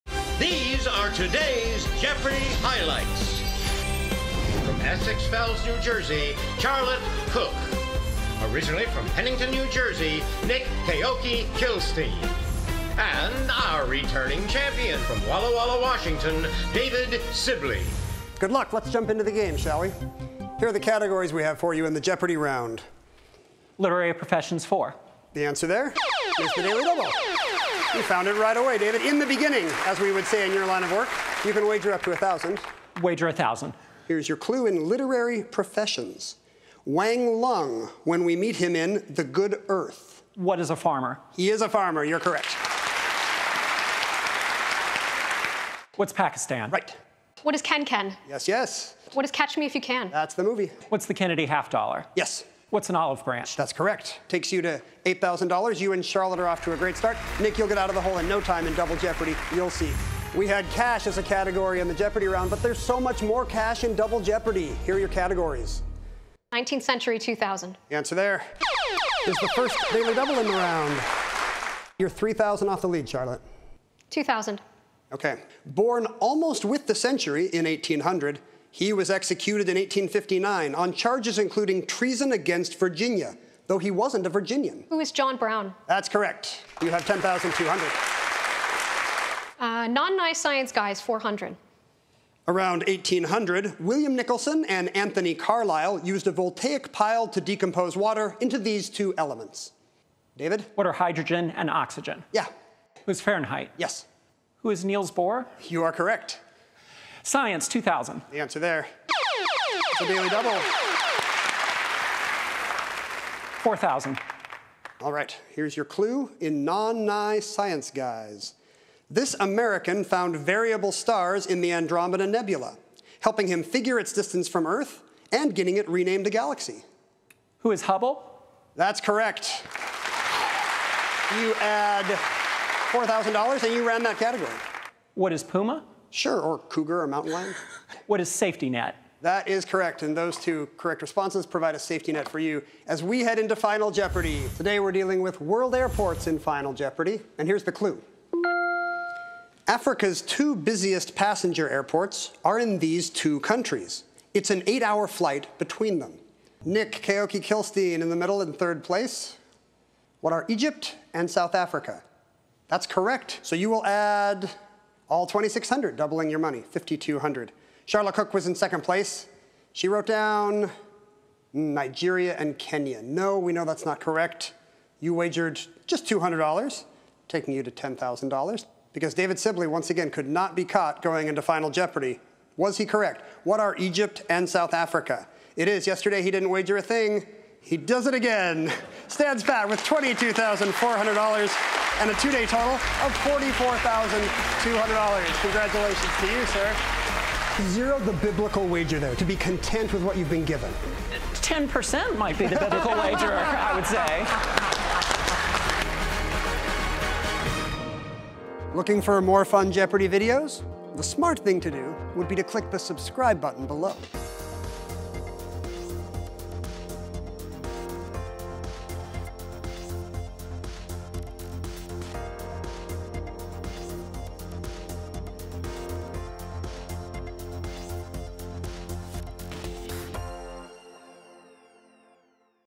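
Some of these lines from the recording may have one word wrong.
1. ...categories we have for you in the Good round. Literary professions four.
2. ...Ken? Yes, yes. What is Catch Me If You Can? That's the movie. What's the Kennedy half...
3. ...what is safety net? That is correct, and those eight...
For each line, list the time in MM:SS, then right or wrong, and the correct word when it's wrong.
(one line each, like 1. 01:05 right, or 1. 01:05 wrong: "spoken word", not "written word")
1. 00:20 wrong: "Jeopardy", not "Good"
2. 00:47 right
3. 02:18 wrong: "two", not "eight".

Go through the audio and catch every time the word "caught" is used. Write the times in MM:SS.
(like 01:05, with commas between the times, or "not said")
03:00.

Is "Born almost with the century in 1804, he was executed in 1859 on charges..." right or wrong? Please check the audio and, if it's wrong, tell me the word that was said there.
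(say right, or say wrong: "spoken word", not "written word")
wrong: "1800", not "1804".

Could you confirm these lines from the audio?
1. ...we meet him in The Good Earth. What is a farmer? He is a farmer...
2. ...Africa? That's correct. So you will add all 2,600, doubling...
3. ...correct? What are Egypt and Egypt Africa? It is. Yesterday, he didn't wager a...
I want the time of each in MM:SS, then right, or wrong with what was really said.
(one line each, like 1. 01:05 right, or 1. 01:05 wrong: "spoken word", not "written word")
1. 00:38 right
2. 02:41 right
3. 03:02 wrong: "South", not "Egypt".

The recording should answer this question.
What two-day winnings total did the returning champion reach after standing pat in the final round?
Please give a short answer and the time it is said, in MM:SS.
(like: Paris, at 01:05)
$44,200, at 03:13.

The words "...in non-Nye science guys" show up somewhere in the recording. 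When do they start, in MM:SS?
01:56.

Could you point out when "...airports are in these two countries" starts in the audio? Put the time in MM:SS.
02:31.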